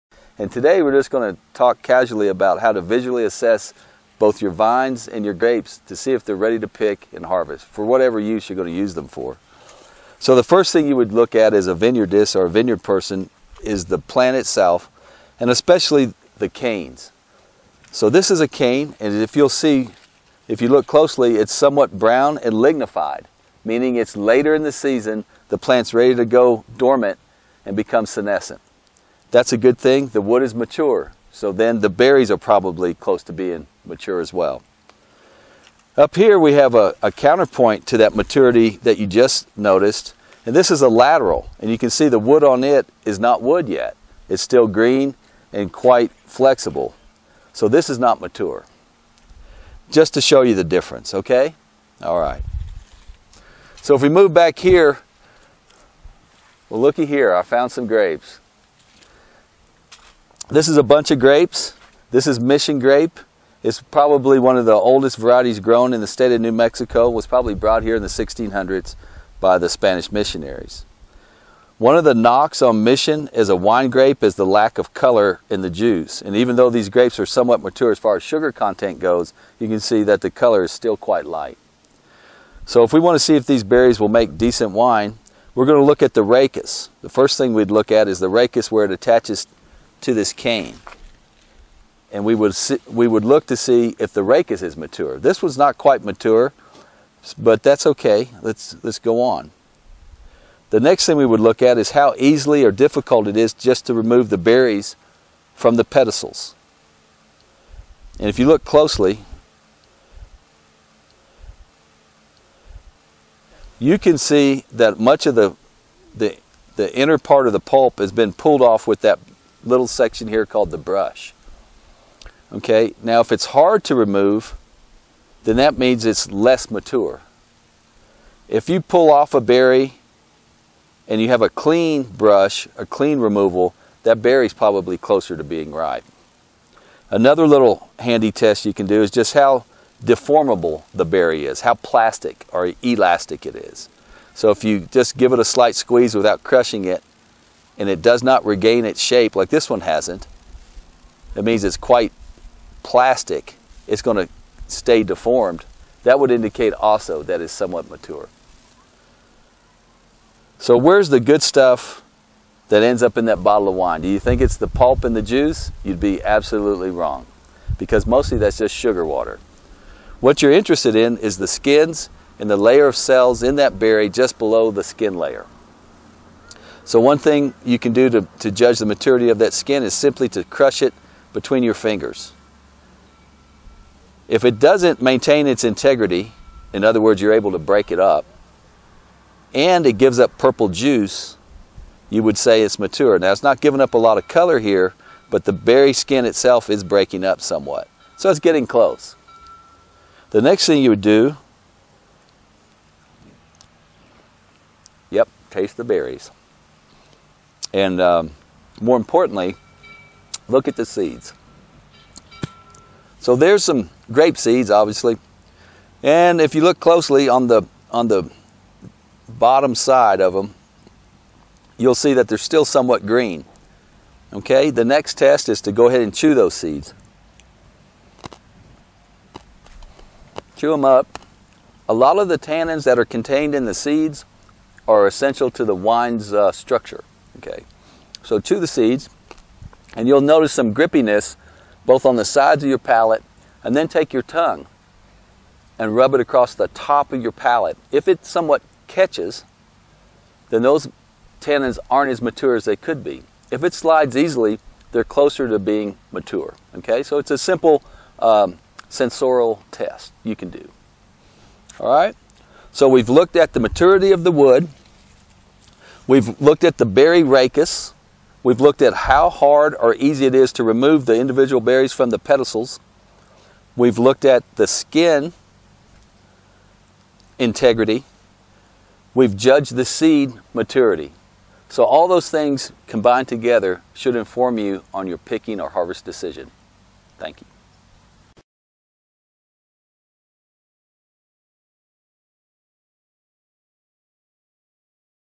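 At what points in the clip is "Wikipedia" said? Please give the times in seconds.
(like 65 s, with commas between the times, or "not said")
not said.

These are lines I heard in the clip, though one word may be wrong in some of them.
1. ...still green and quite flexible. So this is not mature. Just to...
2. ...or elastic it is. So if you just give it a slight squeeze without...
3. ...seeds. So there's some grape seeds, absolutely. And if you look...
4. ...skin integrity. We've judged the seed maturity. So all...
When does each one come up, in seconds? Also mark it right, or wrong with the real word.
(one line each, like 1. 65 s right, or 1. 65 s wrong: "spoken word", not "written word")
1. 44 s right
2. 142 s right
3. 210 s wrong: "obviously", not "absolutely"
4. 274 s right.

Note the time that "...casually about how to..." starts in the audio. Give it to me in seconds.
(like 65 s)
1 s.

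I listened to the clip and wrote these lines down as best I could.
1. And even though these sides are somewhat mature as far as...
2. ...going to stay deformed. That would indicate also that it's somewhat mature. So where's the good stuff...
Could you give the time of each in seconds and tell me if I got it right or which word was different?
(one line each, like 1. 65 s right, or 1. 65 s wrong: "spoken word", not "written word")
1. 76 s wrong: "grapes", not "sides"
2. 154 s right.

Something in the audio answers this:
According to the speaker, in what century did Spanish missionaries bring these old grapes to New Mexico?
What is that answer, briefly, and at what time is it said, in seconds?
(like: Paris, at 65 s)
1600s, at 68 s.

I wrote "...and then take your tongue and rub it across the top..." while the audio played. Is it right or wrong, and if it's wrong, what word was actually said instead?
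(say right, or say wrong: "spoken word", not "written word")
right.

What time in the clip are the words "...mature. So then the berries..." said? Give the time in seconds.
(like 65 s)
30 s.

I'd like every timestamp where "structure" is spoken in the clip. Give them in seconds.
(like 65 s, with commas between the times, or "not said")
236 s.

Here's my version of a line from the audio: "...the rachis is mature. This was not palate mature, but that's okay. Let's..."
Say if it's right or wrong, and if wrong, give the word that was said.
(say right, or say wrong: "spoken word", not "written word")
wrong: "quite", not "palate".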